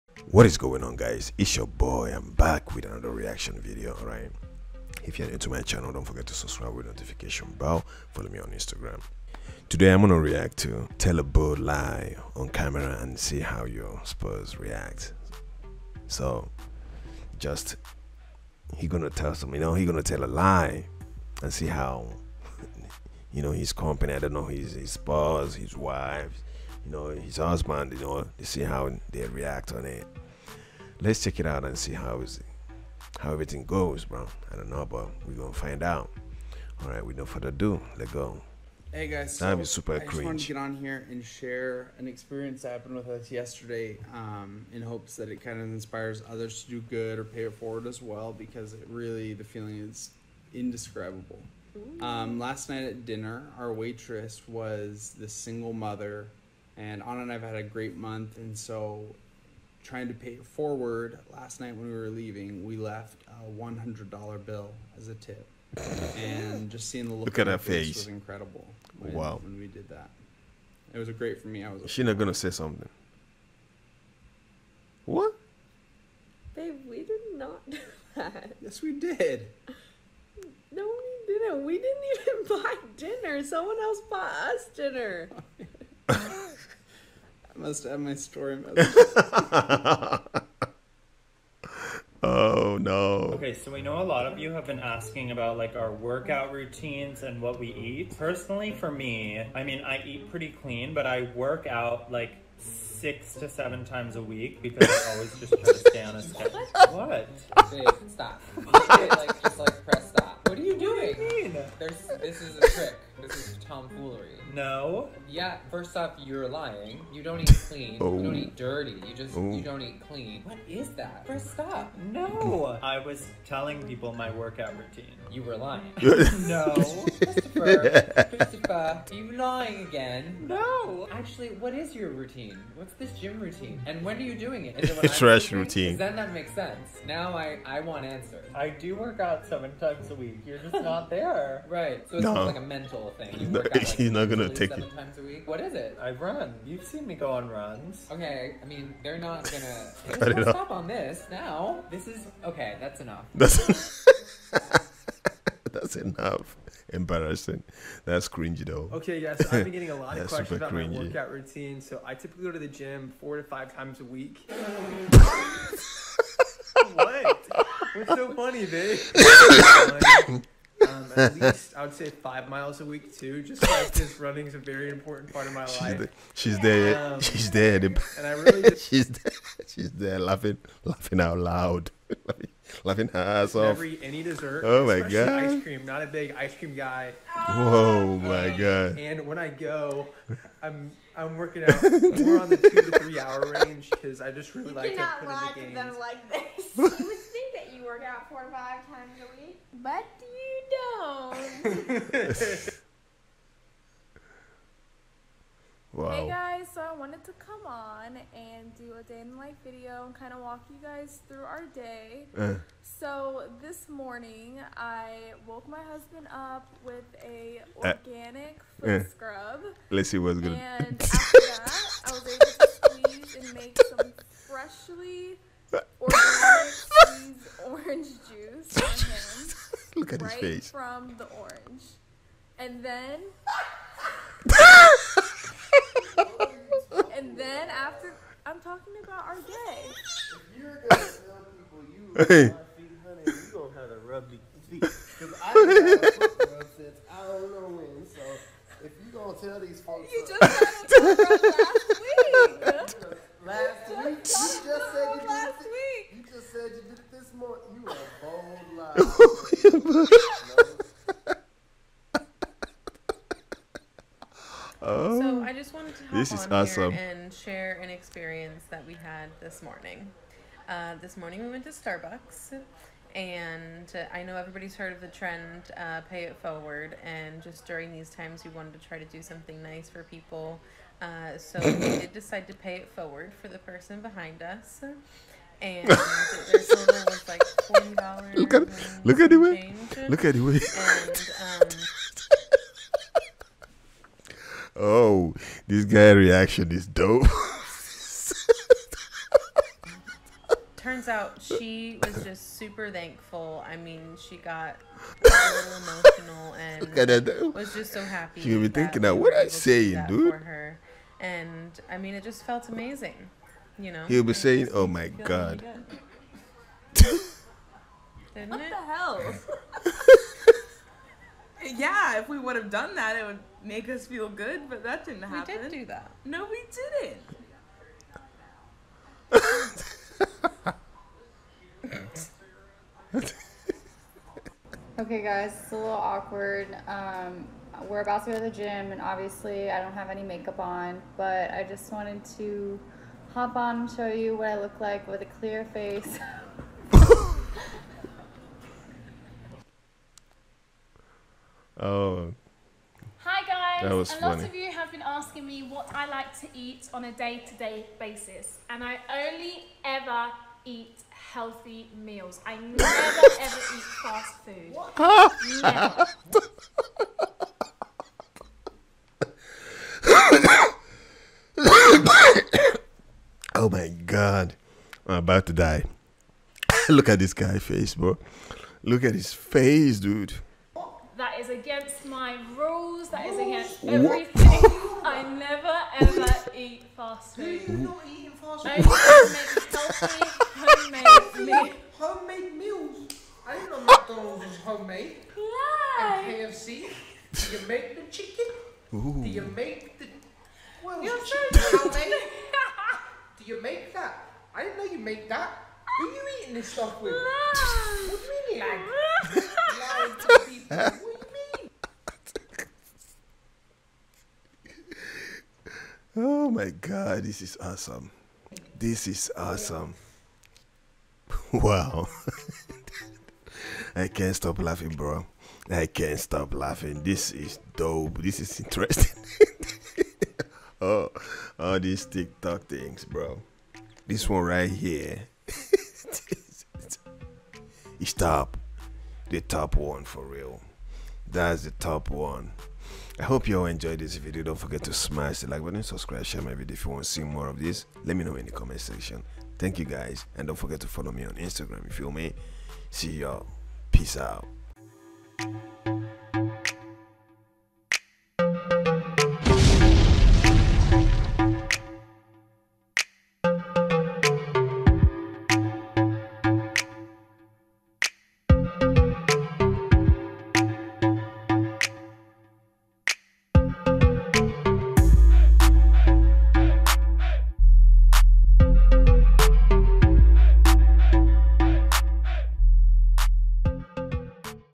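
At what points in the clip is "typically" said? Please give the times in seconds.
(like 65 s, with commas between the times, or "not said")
162 s.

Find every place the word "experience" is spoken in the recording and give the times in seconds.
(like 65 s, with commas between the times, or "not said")
42 s, 267 s.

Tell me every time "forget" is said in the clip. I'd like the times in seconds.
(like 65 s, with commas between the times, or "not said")
6 s, 444 s, 450 s.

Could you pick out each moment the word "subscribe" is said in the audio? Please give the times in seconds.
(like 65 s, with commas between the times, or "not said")
6 s, 445 s.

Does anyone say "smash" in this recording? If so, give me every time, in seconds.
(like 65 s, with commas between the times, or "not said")
444 s.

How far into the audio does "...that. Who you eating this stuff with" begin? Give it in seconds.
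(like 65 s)
405 s.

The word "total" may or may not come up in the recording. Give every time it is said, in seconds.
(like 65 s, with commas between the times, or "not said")
285 s.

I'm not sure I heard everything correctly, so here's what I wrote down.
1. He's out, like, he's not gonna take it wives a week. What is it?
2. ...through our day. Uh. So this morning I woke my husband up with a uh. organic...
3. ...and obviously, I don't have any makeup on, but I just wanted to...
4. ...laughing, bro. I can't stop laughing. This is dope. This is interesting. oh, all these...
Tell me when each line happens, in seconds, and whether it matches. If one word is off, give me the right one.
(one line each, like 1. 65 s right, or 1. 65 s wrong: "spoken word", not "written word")
1. 143 s wrong: "times", not "wives"
2. 211 s right
3. 338 s right
4. 424 s right.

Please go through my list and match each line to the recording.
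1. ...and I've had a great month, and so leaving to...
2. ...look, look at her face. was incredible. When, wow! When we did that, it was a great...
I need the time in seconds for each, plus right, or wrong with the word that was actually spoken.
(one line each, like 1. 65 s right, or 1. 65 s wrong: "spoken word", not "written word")
1. 57 s wrong: "trying", not "leaving"
2. 67 s right.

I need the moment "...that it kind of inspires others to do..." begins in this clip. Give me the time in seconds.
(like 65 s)
45 s.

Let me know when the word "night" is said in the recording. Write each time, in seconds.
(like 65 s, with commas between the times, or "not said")
52 s, 61 s.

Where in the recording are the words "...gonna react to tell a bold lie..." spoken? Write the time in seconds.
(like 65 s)
9 s.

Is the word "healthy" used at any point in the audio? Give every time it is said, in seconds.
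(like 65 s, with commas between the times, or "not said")
361 s, 390 s.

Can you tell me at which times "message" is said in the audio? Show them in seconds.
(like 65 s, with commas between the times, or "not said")
88 s.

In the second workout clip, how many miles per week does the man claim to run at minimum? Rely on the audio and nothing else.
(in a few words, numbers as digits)
5.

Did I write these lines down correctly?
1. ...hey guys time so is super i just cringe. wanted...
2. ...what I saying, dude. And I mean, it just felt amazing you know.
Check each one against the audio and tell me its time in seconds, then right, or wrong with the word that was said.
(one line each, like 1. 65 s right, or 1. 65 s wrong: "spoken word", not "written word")
1. 38 s right
2. 309 s right.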